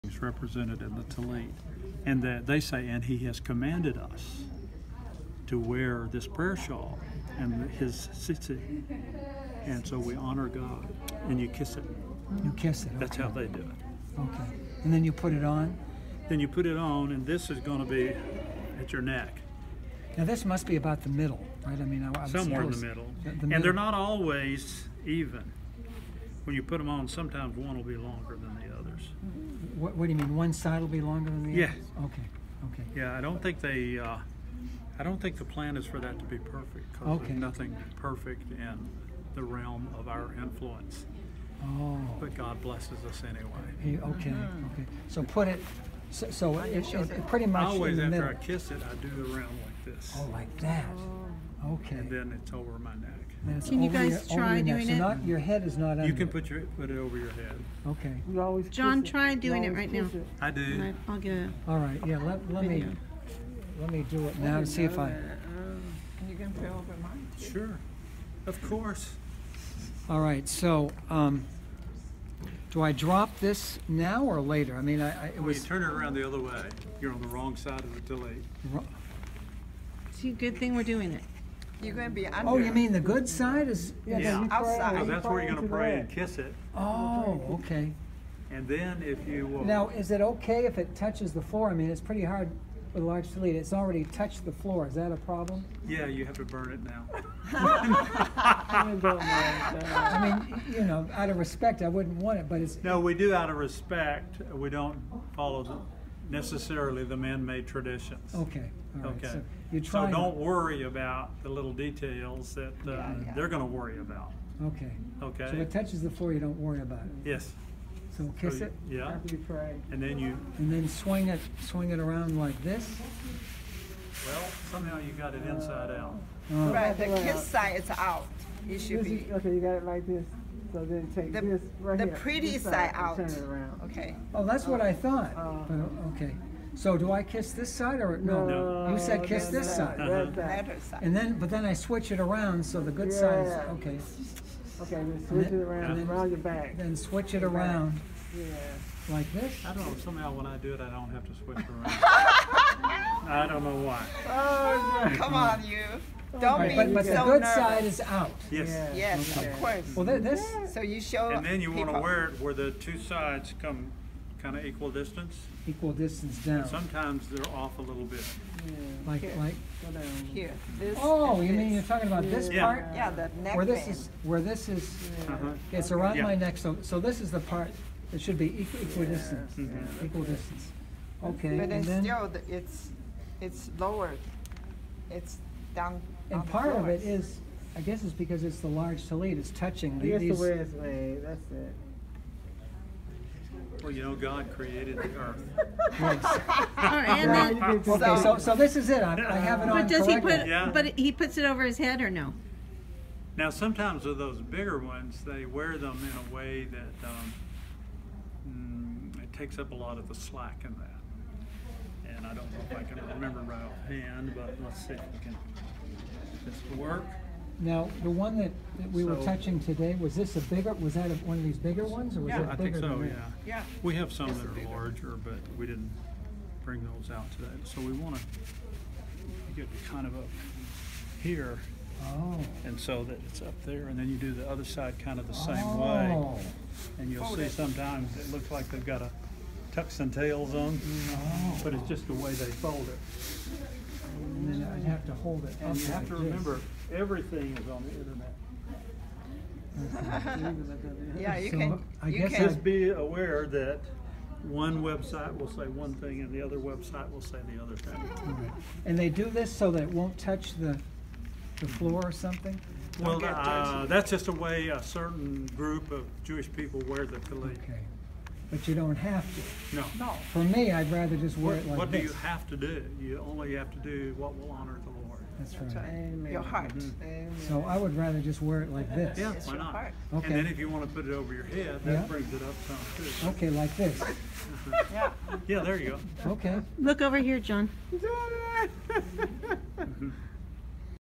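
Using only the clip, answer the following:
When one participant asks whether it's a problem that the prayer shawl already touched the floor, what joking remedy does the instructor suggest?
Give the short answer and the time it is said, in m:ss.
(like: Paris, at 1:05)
Burn it, at 1:36.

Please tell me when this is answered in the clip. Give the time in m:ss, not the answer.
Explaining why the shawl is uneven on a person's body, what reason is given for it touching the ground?
3:08.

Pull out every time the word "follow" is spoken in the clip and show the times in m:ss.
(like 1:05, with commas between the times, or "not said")
1:45.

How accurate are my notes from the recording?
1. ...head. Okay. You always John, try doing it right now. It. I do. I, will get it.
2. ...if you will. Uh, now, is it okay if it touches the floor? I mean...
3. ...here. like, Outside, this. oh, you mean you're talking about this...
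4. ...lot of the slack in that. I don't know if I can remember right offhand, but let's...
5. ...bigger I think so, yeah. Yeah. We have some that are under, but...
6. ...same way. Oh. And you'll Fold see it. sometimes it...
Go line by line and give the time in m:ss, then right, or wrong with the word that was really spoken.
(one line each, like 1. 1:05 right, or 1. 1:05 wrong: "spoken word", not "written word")
1. 0:57 right
2. 1:29 right
3. 2:49 wrong: "Here", not "Outside"
4. 3:29 right
5. 3:42 wrong: "larger", not "under"
6. 3:55 right.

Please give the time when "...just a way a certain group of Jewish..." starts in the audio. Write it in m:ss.
4:24.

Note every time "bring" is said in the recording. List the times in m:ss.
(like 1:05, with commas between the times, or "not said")
3:46, 4:42.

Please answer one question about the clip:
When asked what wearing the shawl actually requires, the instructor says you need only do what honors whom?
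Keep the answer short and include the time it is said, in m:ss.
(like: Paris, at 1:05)
The Lord, at 4:34.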